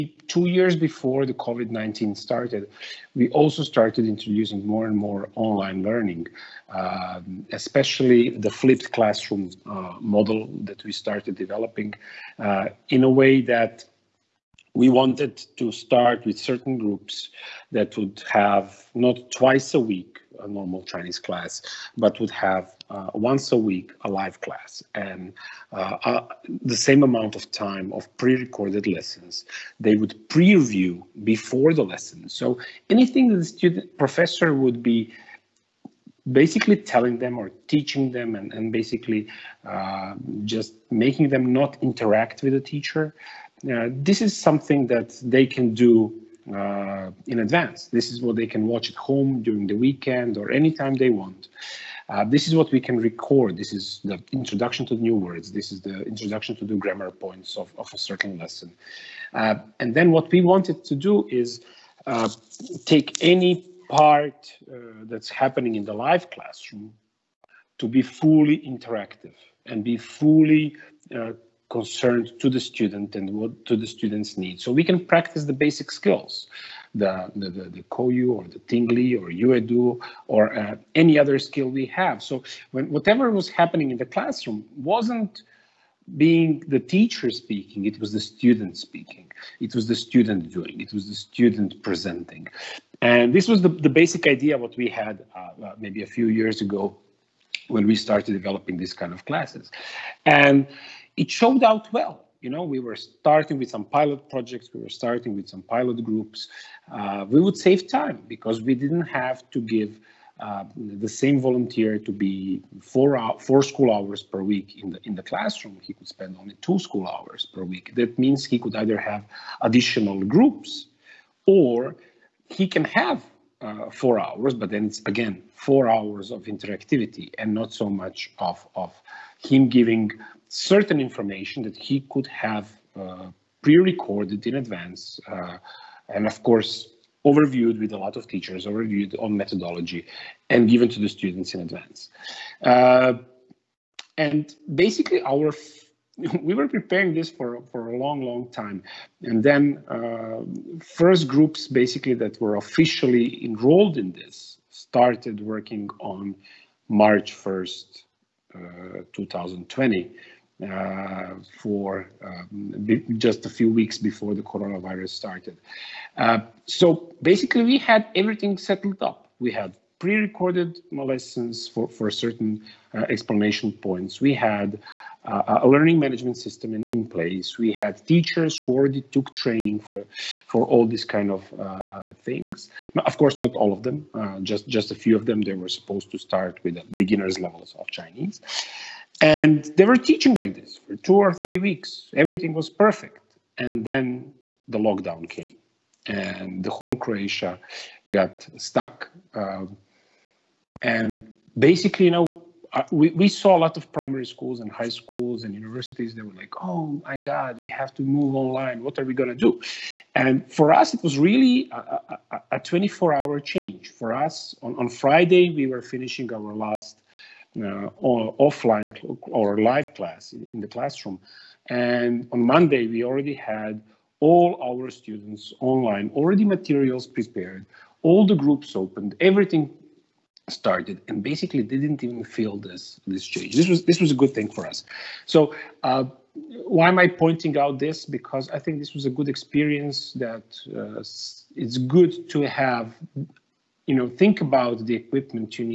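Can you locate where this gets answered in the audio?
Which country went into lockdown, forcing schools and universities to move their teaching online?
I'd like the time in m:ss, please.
3:16.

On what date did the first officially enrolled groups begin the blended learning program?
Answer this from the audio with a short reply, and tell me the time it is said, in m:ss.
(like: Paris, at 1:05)
March 1, 2020, at 2:36.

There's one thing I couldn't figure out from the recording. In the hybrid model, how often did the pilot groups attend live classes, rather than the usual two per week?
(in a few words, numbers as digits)
once a week.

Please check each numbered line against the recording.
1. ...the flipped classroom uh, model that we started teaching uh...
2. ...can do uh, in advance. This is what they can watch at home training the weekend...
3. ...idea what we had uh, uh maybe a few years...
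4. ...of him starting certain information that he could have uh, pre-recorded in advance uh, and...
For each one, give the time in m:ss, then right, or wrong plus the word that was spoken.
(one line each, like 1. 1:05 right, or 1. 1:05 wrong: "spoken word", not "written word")
1. 0:08 wrong: "developing", not "teaching"
2. 0:45 wrong: "during", not "training"
3. 1:34 right
4. 2:08 wrong: "giving", not "starting".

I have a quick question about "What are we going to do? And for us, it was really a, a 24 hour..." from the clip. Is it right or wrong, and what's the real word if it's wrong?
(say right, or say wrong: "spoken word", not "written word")
right.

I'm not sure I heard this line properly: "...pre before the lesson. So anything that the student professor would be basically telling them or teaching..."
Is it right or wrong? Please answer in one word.
right.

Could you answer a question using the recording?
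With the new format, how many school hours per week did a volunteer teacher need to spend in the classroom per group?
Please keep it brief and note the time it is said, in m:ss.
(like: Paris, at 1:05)
2 school hours, at 1:56.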